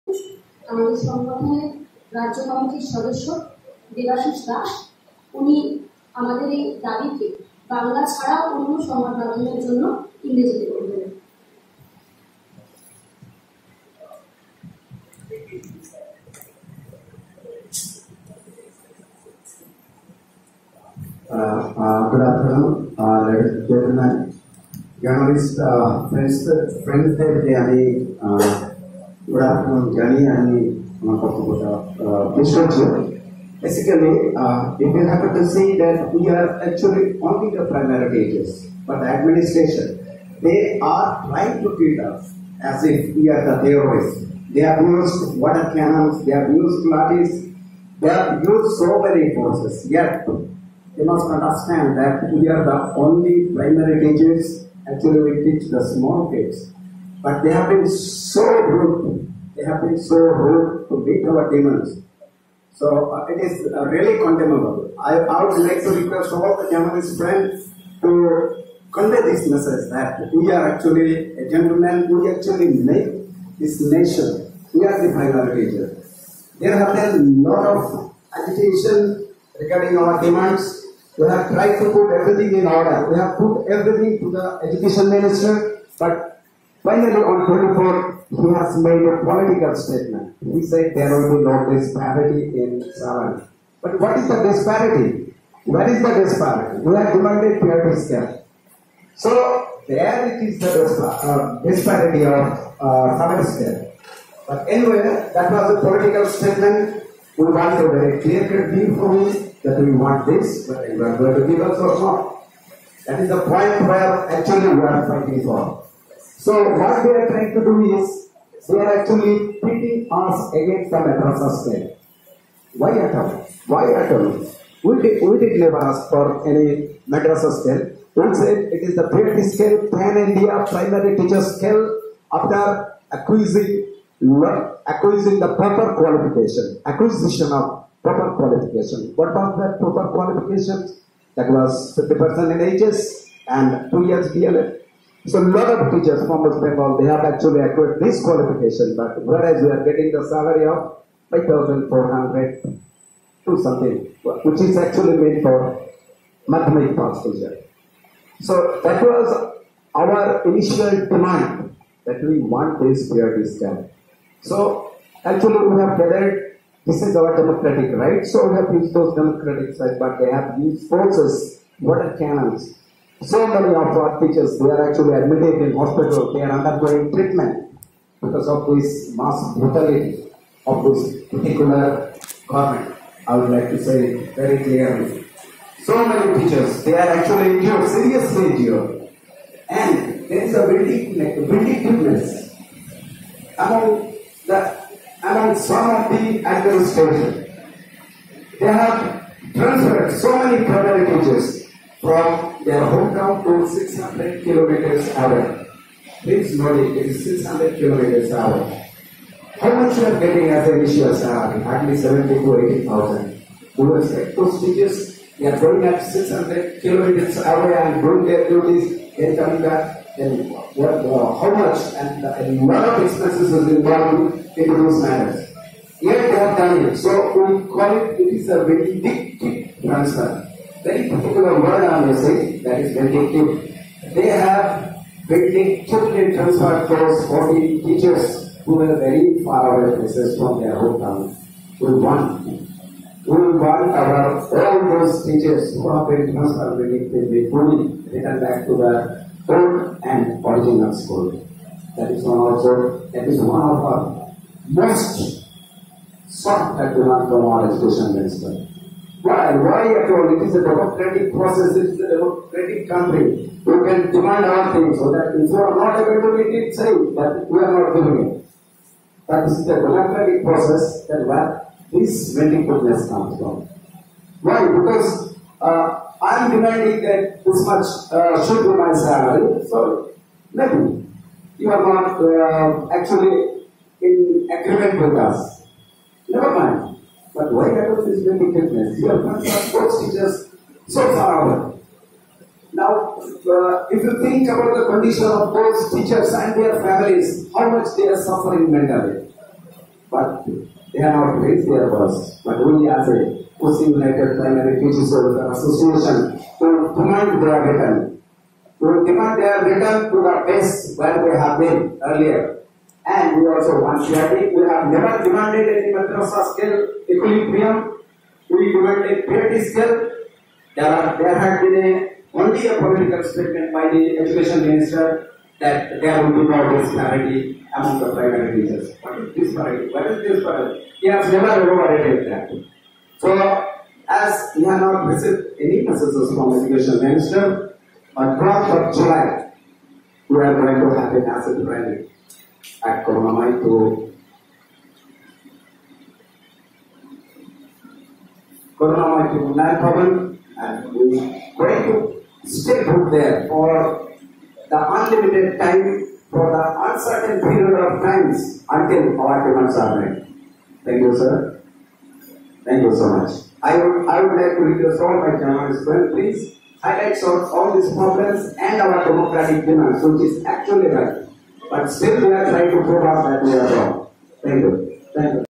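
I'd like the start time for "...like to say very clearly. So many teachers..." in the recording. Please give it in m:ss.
3:03.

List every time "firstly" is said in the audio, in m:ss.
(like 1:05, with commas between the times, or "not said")
not said.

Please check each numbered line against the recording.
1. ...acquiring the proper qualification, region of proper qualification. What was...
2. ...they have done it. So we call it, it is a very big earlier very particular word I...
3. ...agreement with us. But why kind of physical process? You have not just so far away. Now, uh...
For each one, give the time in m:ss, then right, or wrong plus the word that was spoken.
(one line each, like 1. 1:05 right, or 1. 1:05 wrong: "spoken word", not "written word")
1. 2:14 wrong: "acquisition", not "region"
2. 3:46 wrong: "transfer", not "earlier"
3. 4:44 wrong: "indebtedness", not "process".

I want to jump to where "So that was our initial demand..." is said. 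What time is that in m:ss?
2:38.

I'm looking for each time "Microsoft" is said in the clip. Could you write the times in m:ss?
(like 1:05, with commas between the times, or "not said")
not said.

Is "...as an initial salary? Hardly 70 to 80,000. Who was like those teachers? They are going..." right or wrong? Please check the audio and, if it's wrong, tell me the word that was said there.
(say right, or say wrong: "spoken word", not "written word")
right.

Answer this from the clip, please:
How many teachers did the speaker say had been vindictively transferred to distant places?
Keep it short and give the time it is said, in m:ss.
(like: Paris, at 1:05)
40, at 3:57.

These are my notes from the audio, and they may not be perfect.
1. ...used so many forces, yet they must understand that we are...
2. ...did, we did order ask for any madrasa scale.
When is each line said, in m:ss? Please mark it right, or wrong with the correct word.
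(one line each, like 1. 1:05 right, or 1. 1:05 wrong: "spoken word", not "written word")
1. 0:48 right
2. 2:05 wrong: "never", not "order".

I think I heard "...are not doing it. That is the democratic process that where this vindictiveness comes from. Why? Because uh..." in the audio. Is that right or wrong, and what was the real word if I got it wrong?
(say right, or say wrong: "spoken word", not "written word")
right.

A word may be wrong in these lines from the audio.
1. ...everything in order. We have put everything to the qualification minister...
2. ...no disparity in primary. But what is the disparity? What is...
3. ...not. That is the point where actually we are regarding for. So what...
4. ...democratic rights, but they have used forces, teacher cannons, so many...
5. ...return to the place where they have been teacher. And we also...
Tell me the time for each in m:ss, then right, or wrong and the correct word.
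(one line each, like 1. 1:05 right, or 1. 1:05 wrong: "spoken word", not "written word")
1. 1:22 wrong: "education", not "qualification"
2. 1:31 wrong: "salary", not "primary"
3. 1:51 wrong: "fighting", not "regarding"
4. 2:49 wrong: "water", not "teacher"
5. 5:09 wrong: "earlier", not "teacher".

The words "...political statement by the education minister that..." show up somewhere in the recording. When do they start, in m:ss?
5:22.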